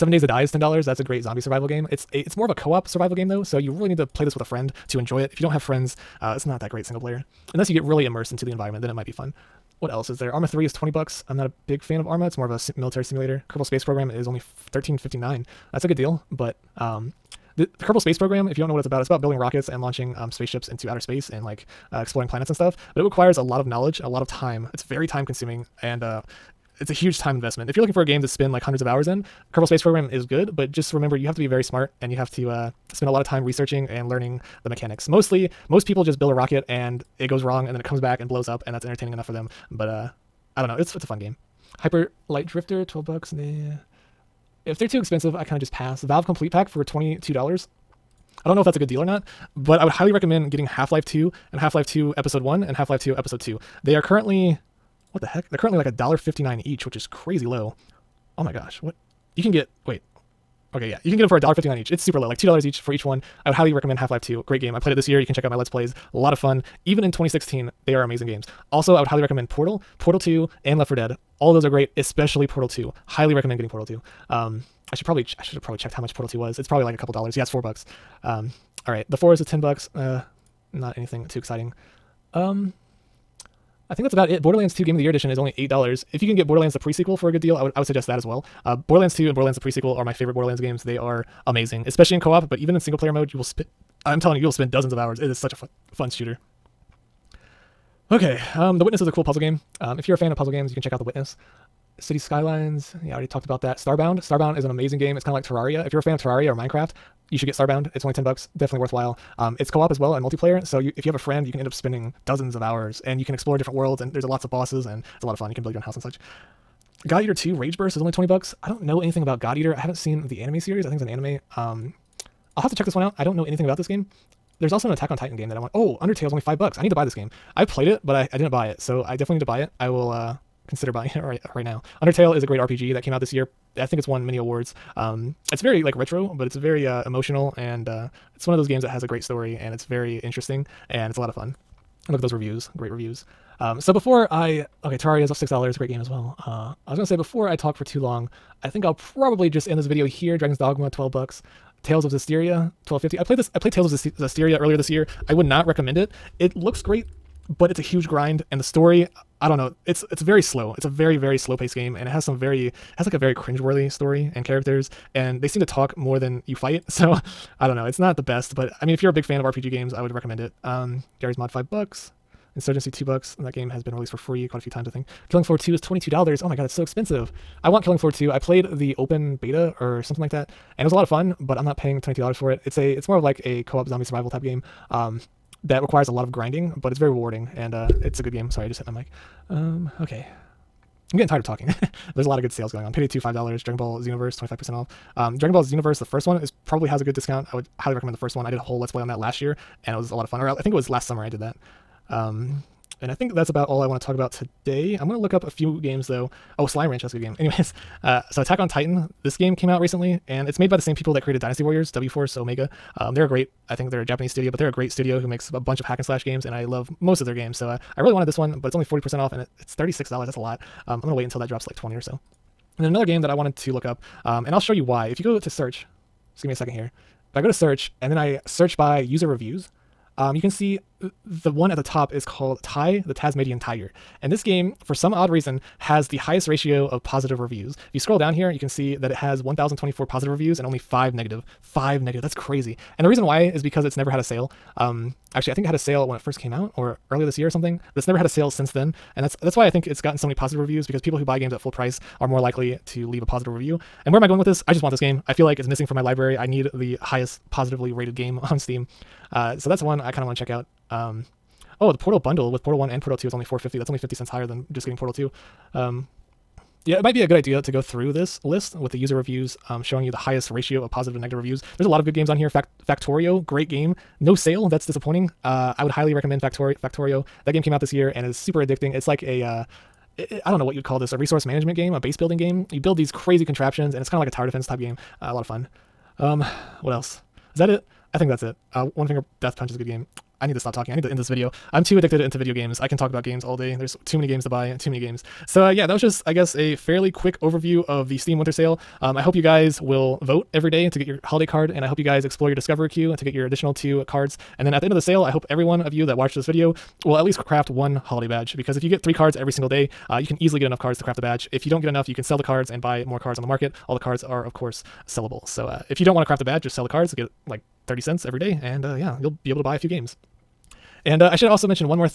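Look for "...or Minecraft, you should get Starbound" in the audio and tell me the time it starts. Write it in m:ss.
1:46.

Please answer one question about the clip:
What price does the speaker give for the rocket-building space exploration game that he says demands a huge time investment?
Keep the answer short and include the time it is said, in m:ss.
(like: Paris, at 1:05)
$13.59, at 0:14.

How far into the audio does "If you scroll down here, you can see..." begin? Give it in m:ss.
3:57.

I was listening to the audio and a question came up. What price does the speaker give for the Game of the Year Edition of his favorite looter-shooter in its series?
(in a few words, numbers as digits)
$8.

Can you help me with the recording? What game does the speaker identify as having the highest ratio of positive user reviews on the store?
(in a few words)
Ty the Tasmanian Tiger.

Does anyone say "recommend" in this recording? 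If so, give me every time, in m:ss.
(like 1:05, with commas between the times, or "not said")
0:50, 1:03, 1:09, 1:13, 2:35, 2:50, 3:17, 4:36.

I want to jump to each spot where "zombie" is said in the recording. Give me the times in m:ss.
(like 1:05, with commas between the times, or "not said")
0:01, 3:03.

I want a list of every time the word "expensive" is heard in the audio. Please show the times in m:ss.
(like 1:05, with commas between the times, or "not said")
0:44, 2:56.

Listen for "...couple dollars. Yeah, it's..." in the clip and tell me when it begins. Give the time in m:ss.
1:16.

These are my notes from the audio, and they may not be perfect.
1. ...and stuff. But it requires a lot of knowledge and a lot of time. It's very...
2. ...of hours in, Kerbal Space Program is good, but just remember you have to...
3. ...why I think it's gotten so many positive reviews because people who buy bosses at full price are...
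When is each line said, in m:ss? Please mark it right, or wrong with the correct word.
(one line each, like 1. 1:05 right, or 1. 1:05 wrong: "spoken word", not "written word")
1. 0:22 right
2. 0:28 right
3. 4:09 wrong: "games", not "bosses".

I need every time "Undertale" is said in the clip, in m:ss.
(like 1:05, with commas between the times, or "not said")
2:05, 2:12.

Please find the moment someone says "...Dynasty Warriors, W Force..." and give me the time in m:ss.
3:31.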